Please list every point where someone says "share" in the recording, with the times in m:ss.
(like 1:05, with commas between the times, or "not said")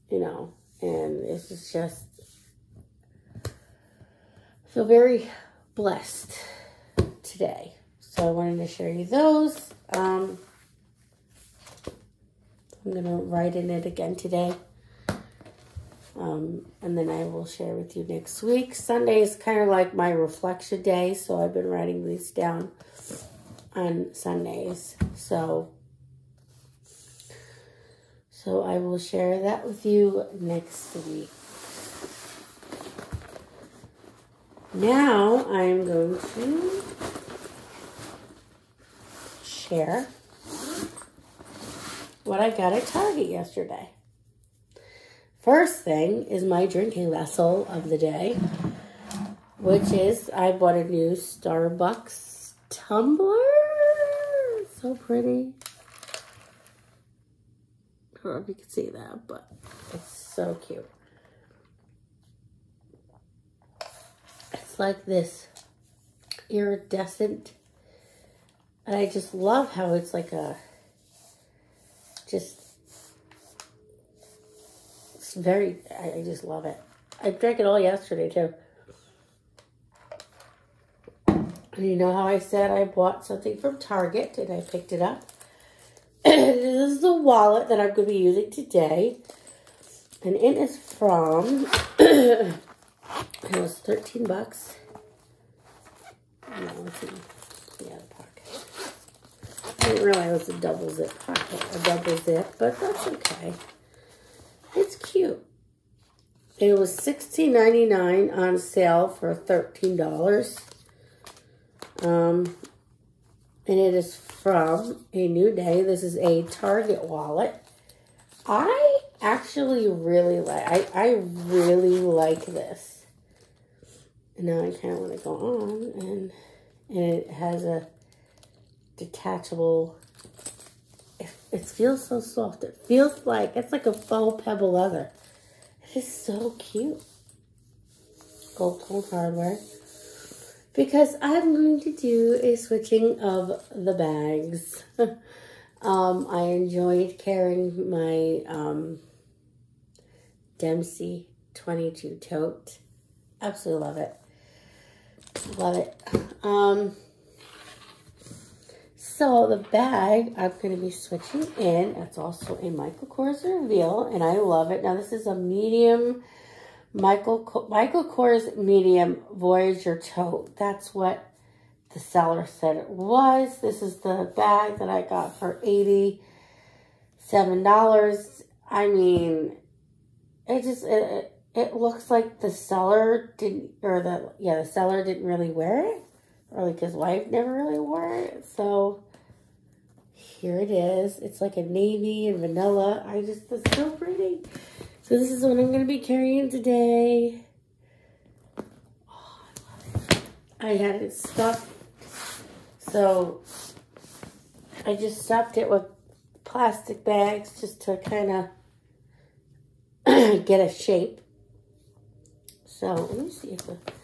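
0:08, 0:17, 0:28, 0:39.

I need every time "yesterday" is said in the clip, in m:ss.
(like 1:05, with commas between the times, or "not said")
0:43, 1:17.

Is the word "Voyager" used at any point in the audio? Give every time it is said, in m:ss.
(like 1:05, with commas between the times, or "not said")
2:49.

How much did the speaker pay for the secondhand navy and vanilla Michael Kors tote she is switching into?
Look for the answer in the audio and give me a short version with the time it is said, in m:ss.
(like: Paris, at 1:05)
$87, at 2:55.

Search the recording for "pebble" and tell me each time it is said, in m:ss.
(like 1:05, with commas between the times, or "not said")
2:14.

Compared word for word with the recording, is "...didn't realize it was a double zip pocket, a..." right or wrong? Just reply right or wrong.
right.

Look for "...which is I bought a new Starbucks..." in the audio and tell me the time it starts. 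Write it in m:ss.
0:49.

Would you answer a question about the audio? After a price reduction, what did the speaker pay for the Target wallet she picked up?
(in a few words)
$13.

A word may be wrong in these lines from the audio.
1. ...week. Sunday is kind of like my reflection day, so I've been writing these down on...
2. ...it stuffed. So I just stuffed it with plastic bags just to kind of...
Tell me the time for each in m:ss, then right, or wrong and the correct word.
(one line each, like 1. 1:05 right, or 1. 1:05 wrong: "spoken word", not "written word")
1. 0:18 right
2. 3:20 right.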